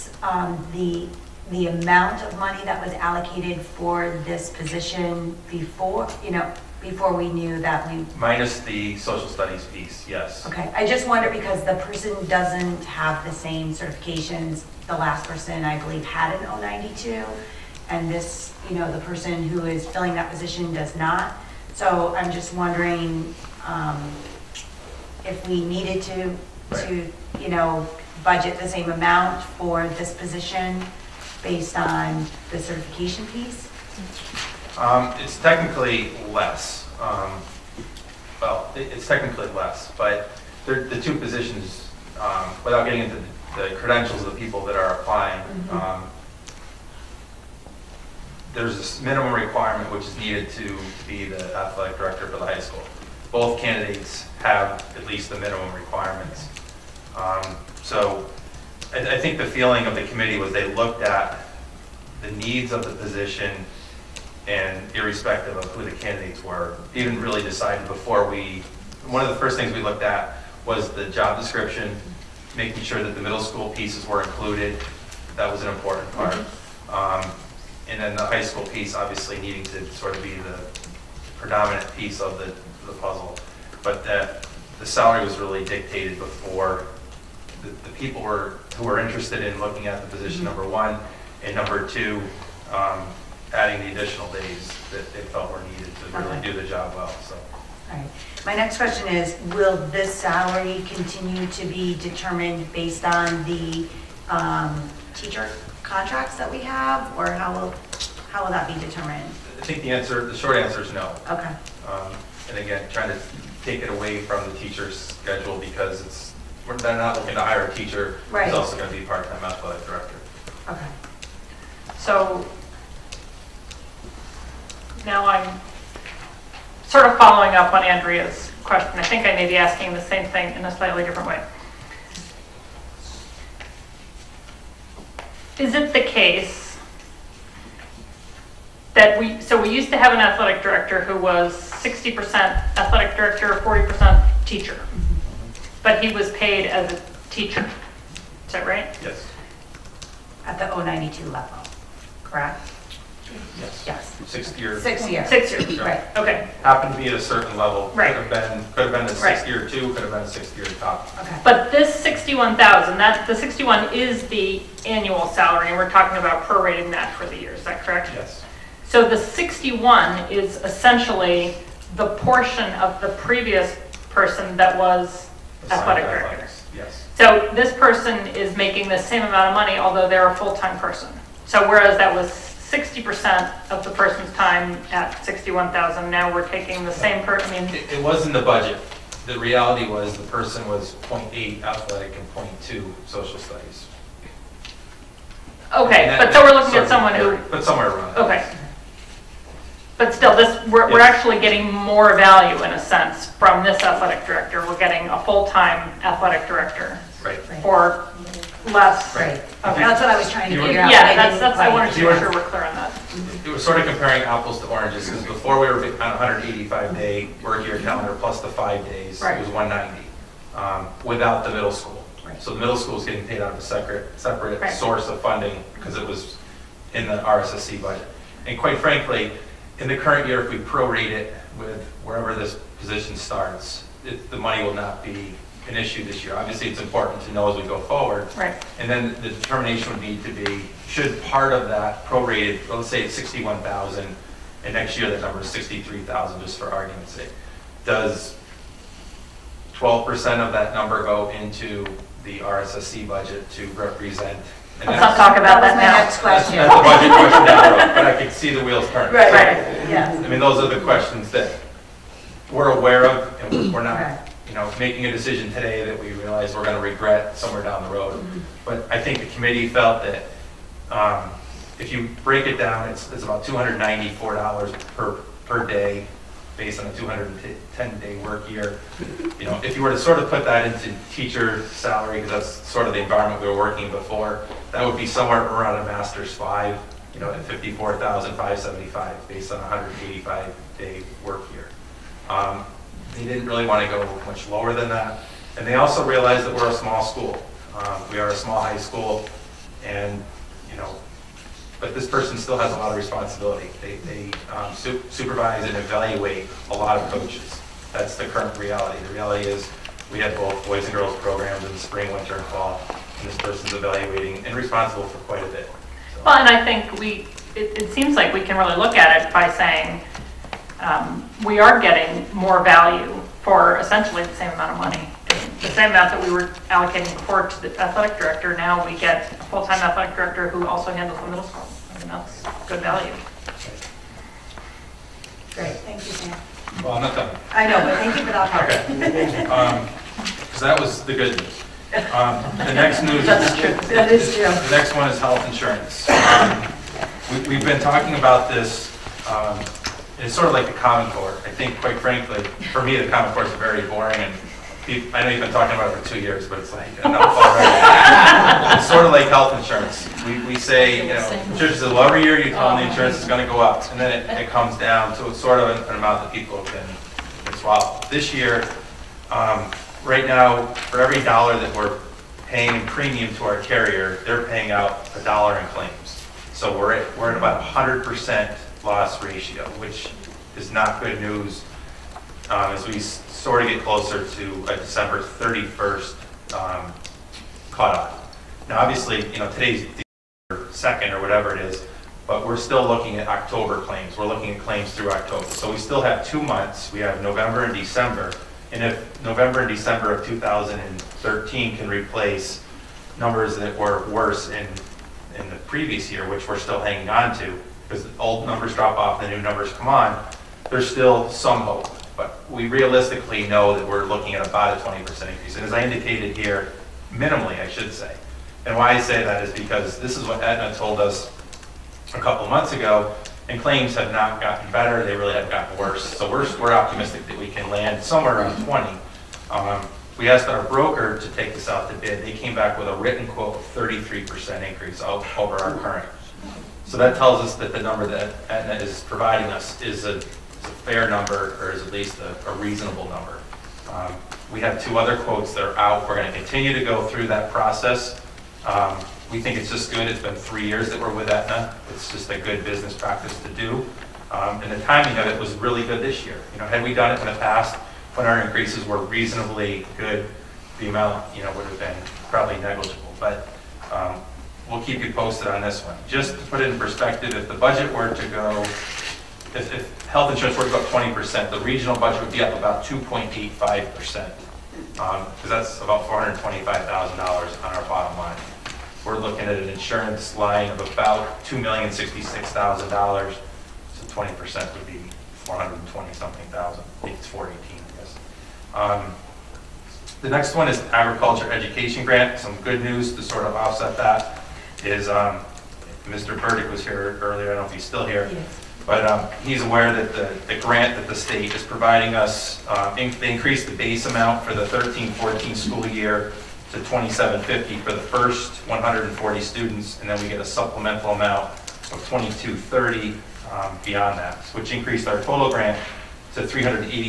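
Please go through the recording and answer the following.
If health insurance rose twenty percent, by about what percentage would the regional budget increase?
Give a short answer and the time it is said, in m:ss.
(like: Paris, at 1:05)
2.85%, at 7:52.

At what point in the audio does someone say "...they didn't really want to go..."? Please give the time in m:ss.
4:53.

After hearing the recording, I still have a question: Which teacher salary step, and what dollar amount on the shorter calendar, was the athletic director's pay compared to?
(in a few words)
Master's five, 54,575.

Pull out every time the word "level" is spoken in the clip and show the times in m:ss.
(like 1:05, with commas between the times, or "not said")
2:31, 2:37.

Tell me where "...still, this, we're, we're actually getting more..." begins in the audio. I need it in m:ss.
3:20.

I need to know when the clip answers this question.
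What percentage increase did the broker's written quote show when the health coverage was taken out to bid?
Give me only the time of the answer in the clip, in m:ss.
7:13.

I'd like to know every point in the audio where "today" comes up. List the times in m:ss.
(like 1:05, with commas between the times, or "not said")
4:25, 6:29.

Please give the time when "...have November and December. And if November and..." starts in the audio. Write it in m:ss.
6:36.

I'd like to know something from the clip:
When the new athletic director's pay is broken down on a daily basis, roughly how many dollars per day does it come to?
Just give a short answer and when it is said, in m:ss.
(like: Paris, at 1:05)
$294, at 4:33.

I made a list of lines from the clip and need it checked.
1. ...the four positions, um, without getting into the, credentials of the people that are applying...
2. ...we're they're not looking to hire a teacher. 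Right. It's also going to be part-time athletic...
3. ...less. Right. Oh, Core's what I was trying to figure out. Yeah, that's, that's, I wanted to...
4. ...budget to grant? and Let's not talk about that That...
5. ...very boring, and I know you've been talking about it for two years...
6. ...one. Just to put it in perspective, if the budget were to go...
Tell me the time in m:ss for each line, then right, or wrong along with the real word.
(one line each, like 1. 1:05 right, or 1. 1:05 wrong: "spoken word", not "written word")
1. 0:40 wrong: "two", not "four"
2. 1:56 right
3. 3:28 wrong: "That", not "Core"
4. 4:13 wrong: "represent", not "grant"
5. 5:53 right
6. 7:45 right.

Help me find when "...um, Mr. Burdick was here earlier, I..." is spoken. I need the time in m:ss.
8:15.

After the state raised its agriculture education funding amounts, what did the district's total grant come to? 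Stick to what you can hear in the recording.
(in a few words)
387,230.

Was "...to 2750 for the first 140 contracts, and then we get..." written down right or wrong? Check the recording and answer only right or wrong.
wrong.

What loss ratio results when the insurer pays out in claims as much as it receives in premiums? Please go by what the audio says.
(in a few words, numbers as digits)
100 percent.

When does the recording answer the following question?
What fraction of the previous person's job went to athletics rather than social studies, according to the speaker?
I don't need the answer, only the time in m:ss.
3:11.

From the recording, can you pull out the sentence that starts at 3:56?
Obviously, it's important to know as we go forward.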